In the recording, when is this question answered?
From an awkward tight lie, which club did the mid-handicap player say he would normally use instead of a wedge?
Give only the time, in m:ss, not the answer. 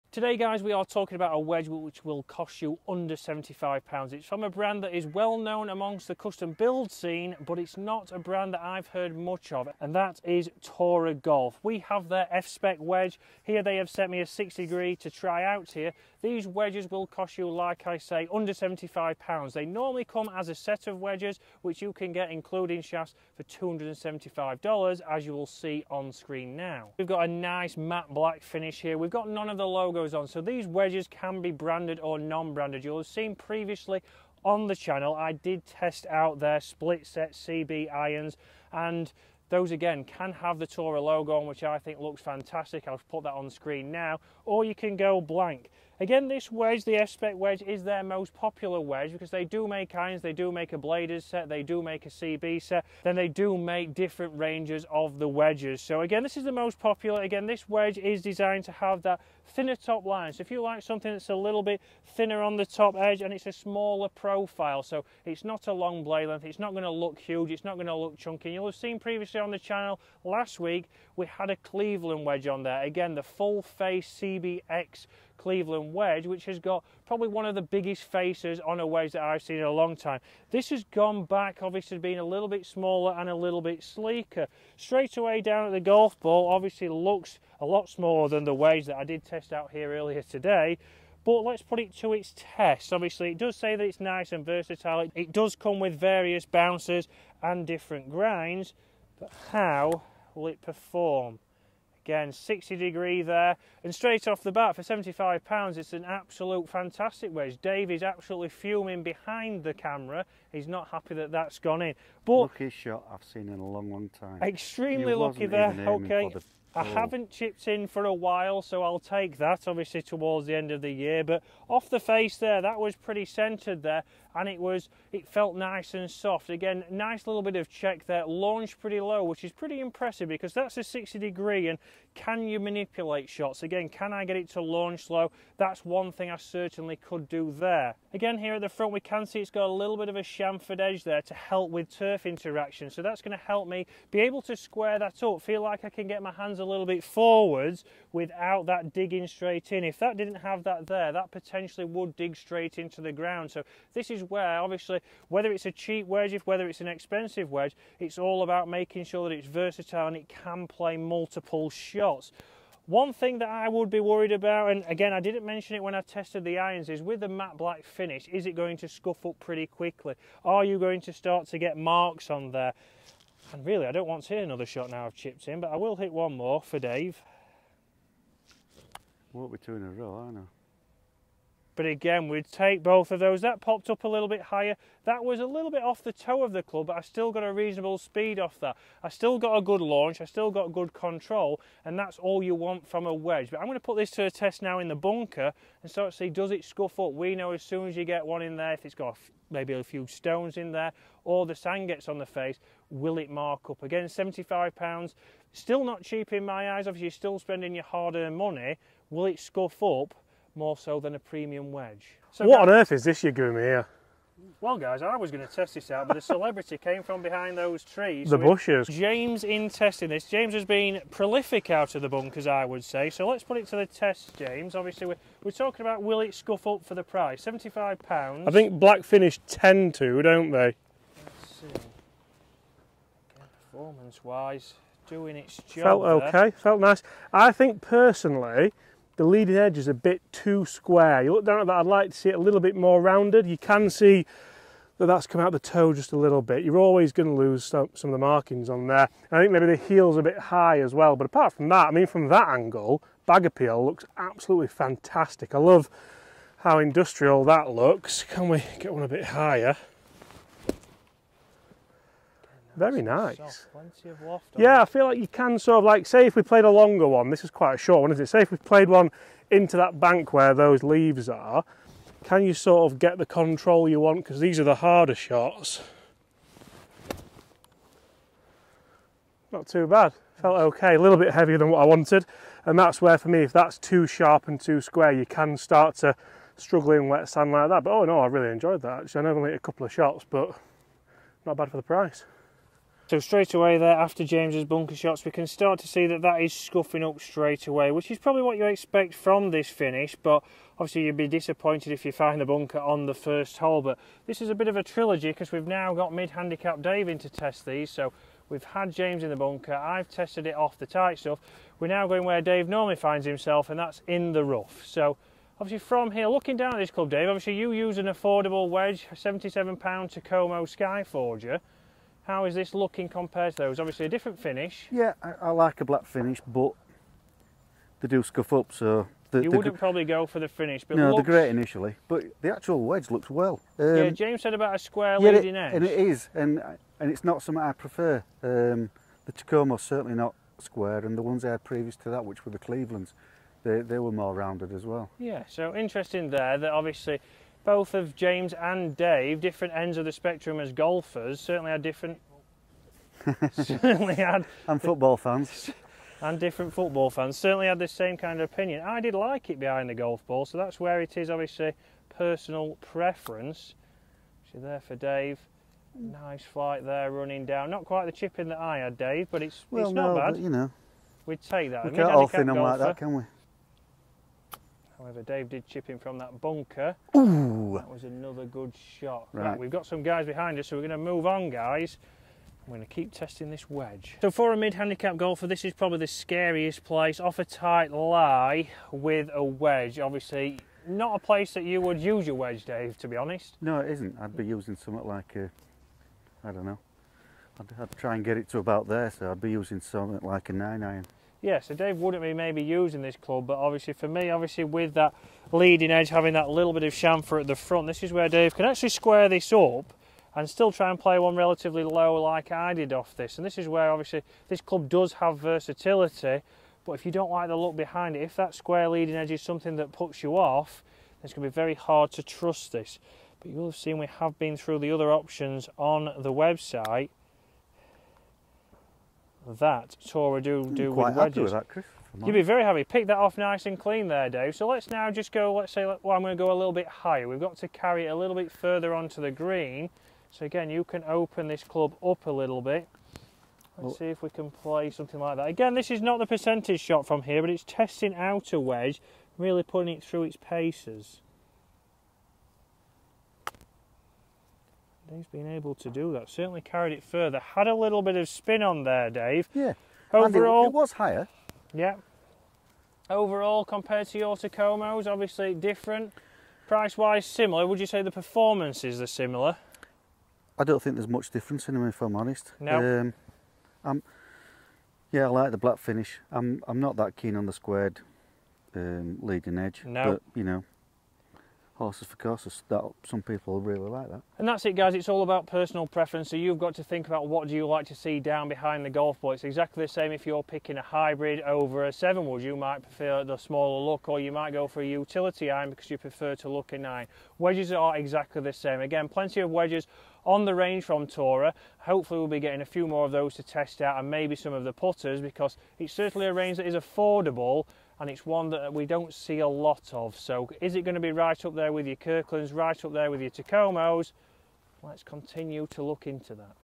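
6:40.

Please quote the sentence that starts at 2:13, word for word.
Again, can I get it to launch low?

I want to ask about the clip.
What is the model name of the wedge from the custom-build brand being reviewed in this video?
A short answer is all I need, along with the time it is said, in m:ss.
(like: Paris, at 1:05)
F-Spec, at 0:12.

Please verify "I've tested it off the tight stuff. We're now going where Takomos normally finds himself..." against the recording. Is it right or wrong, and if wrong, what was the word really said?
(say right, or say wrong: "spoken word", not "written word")
wrong: "Dave", not "Takomos".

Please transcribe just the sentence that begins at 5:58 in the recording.
I did like it behind the golf ball, so that's where it is, obviously, personal preference.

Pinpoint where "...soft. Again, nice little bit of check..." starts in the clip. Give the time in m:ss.
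2:06.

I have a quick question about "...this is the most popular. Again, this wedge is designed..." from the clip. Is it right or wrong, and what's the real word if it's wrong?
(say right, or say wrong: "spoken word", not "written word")
right.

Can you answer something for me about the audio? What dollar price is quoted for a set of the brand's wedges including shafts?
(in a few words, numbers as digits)
$275.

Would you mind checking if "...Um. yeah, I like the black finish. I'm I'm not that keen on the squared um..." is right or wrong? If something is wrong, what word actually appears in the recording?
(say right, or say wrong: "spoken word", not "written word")
right.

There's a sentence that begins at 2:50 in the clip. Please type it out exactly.
Are you going to start to get marks on there?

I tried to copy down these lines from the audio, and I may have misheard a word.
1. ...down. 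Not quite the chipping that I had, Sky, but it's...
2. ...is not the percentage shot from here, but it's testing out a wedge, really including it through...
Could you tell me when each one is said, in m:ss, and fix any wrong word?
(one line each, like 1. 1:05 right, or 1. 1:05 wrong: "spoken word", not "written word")
1. 6:07 wrong: "Dave", not "Sky"
2. 7:25 wrong: "putting", not "including".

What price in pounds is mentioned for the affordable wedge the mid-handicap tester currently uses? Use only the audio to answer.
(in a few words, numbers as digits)
£77.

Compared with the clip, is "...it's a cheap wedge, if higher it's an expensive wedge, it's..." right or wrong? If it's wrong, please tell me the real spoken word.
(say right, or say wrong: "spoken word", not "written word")
wrong: "whether", not "higher".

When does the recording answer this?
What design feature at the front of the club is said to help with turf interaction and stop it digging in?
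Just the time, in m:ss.
2:20.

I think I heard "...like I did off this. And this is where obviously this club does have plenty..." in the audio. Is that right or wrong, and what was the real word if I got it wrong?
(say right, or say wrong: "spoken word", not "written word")
wrong: "versatility", not "plenty".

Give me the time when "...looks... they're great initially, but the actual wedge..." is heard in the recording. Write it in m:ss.
5:31.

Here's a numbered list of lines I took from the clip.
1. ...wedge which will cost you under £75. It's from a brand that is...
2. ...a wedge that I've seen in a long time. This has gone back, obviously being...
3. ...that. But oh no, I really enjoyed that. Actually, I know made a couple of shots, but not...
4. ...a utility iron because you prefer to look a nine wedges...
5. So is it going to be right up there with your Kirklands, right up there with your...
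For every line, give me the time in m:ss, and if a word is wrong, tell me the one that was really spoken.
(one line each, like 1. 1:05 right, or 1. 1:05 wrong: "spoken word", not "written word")
1. 0:01 right
2. 1:18 right
3. 4:47 right
4. 8:14 right
5. 8:30 right.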